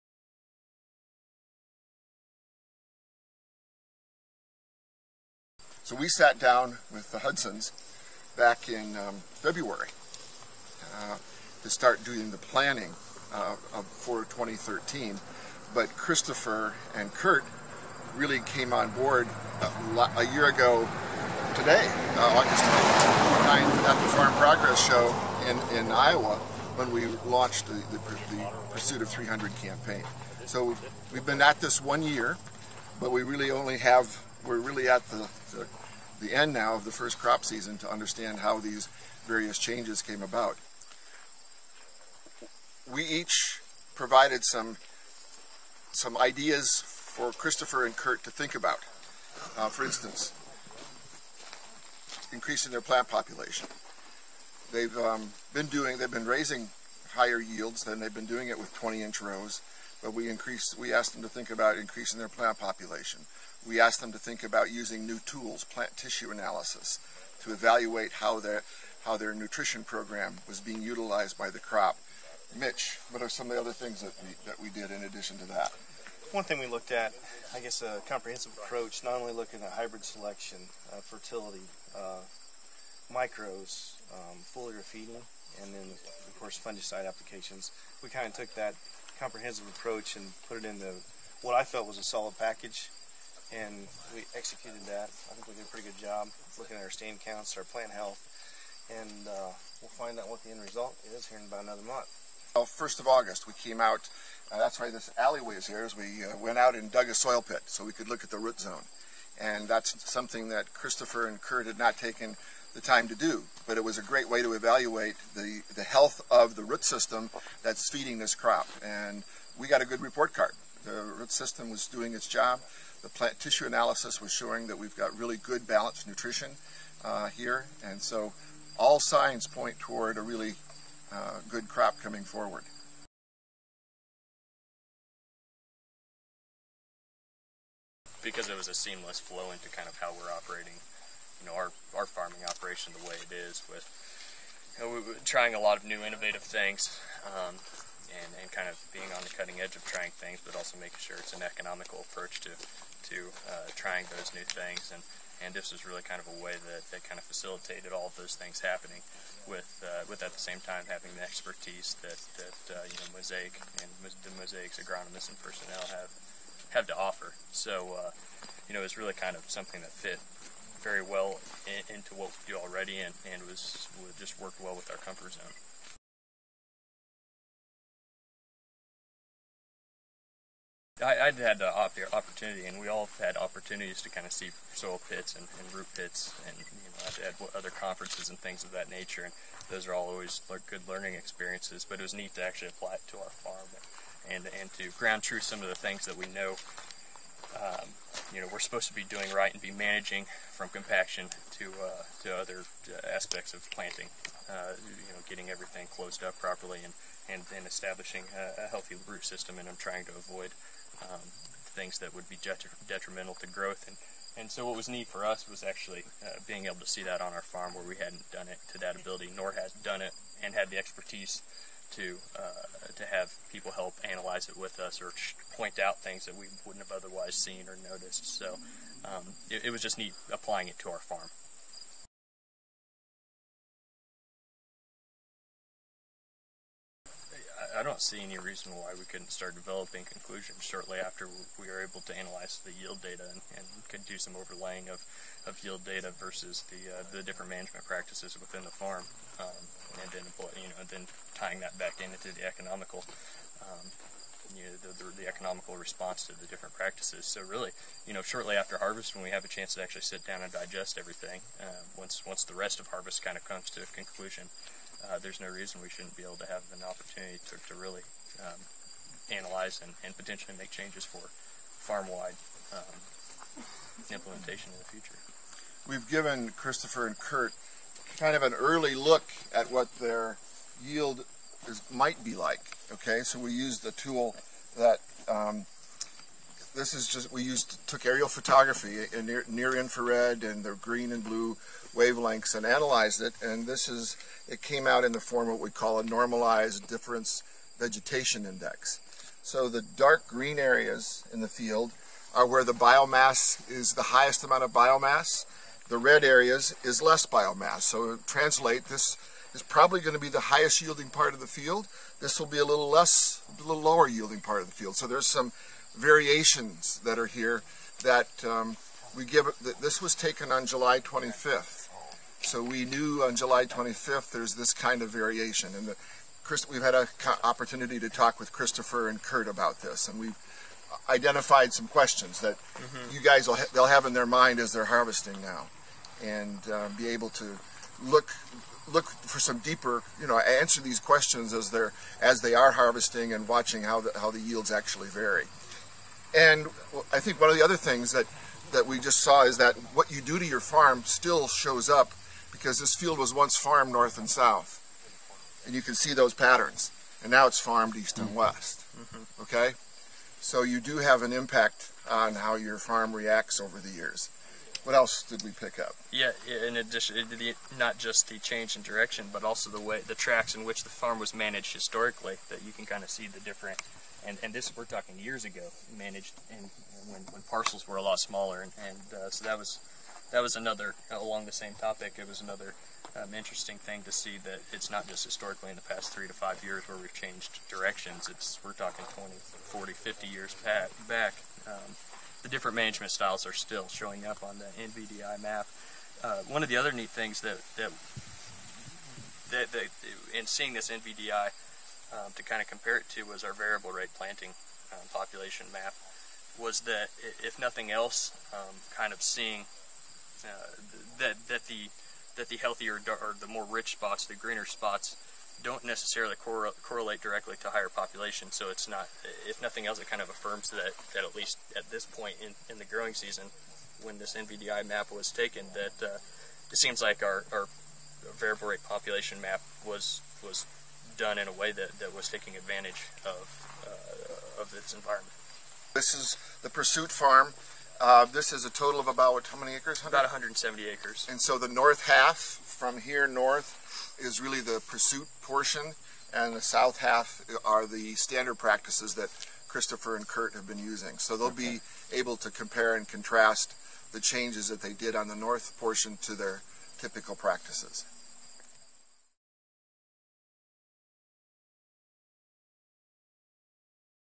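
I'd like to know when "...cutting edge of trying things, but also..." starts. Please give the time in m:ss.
2:29.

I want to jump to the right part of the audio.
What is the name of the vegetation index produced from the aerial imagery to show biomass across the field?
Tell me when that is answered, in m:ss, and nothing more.
4:56.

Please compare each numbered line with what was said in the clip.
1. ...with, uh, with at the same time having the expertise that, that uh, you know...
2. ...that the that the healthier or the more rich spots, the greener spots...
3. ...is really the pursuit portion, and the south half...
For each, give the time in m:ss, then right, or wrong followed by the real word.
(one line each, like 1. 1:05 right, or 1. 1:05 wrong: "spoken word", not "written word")
1. 2:39 right
2. 6:51 right
3. 7:24 right.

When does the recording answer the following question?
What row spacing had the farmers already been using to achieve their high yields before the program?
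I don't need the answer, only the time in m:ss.
0:58.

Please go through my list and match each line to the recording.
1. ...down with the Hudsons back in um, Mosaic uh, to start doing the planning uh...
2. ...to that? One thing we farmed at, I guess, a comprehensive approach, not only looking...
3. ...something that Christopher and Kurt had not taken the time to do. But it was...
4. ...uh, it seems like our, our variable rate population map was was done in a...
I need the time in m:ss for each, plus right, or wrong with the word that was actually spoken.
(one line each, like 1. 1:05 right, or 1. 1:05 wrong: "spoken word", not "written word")
1. 0:06 wrong: "February", not "Mosaic"
2. 1:15 wrong: "looked", not "farmed"
3. 1:50 right
4. 7:06 right.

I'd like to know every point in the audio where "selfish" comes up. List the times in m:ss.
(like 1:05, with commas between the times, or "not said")
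not said.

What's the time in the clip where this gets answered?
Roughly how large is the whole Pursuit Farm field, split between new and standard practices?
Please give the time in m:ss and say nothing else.
7:20.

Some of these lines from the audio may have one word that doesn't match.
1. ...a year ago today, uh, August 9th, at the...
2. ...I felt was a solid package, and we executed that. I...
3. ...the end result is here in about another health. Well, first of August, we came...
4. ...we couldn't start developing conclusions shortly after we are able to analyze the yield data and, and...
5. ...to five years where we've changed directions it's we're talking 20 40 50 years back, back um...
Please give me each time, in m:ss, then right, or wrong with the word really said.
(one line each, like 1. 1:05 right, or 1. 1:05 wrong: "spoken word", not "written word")
1. 0:20 right
2. 1:31 right
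3. 1:40 wrong: "month", not "health"
4. 3:58 right
5. 6:26 right.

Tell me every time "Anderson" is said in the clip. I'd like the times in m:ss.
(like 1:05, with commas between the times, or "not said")
not said.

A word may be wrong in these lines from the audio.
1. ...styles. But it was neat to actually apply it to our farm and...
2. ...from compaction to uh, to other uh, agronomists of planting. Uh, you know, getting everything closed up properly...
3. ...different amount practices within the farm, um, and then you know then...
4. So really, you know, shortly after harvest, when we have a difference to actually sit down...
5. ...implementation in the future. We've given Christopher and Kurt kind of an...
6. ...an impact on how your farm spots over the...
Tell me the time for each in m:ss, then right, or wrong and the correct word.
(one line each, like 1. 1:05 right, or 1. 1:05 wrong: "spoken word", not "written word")
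1. 3:11 wrong: "experiences", not "styles"
2. 3:20 wrong: "aspects", not "agronomists"
3. 4:07 wrong: "management", not "amount"
4. 4:17 wrong: "chance", not "difference"
5. 4:34 right
6. 6:01 wrong: "reacts", not "spots".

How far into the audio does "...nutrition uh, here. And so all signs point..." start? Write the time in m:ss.
2:06.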